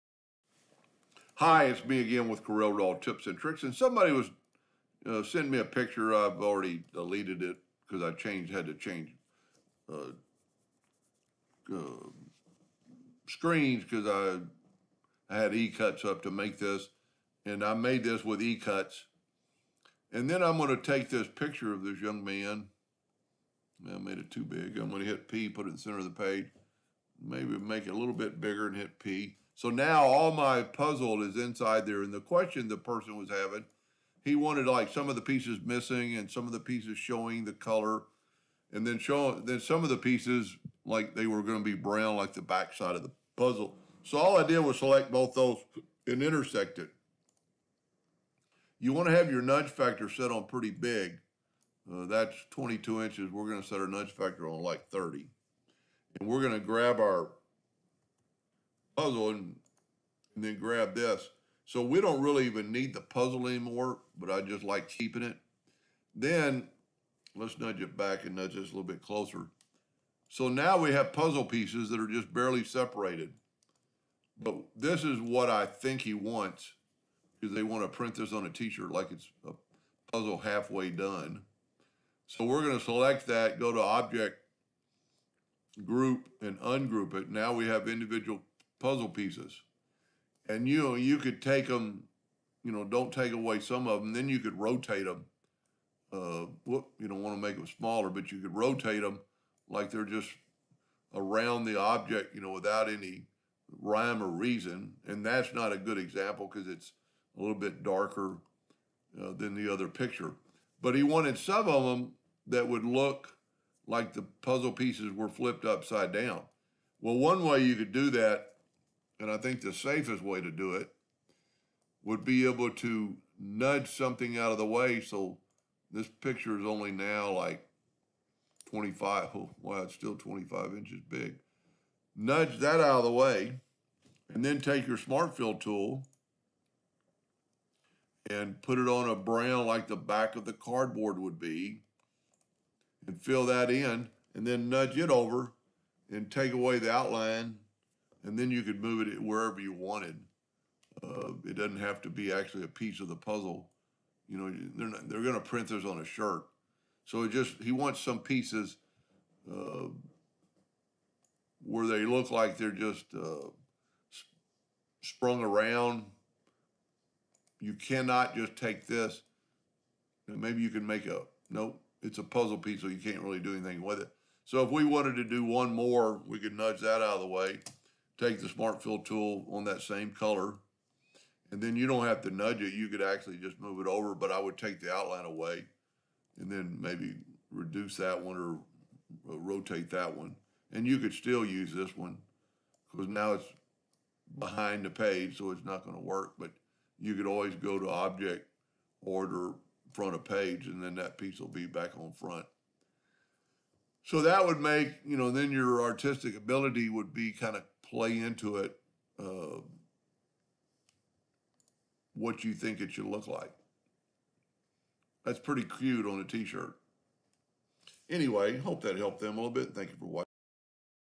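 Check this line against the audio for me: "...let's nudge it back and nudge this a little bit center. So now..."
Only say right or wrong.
wrong.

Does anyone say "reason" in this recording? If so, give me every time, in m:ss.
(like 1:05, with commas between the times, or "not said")
1:44.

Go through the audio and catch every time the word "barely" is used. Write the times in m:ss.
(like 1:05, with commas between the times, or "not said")
1:12.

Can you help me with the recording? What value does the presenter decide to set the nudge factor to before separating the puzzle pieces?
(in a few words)
30.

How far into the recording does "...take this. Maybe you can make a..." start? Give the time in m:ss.
2:48.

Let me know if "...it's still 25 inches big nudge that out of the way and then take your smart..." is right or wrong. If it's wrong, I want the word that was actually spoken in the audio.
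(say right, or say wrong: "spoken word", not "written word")
right.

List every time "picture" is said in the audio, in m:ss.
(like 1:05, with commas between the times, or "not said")
0:05, 0:21, 1:49, 2:06.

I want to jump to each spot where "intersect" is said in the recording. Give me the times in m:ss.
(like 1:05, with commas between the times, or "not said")
0:46.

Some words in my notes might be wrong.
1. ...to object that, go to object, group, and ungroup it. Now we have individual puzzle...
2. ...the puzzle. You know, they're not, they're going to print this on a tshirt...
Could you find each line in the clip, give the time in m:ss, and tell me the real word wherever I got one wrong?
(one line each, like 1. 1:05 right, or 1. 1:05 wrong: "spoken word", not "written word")
1. 1:22 wrong: "select", not "object"
2. 2:33 wrong: "shirt", not "tshirt".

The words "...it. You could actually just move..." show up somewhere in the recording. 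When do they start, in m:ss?
3:02.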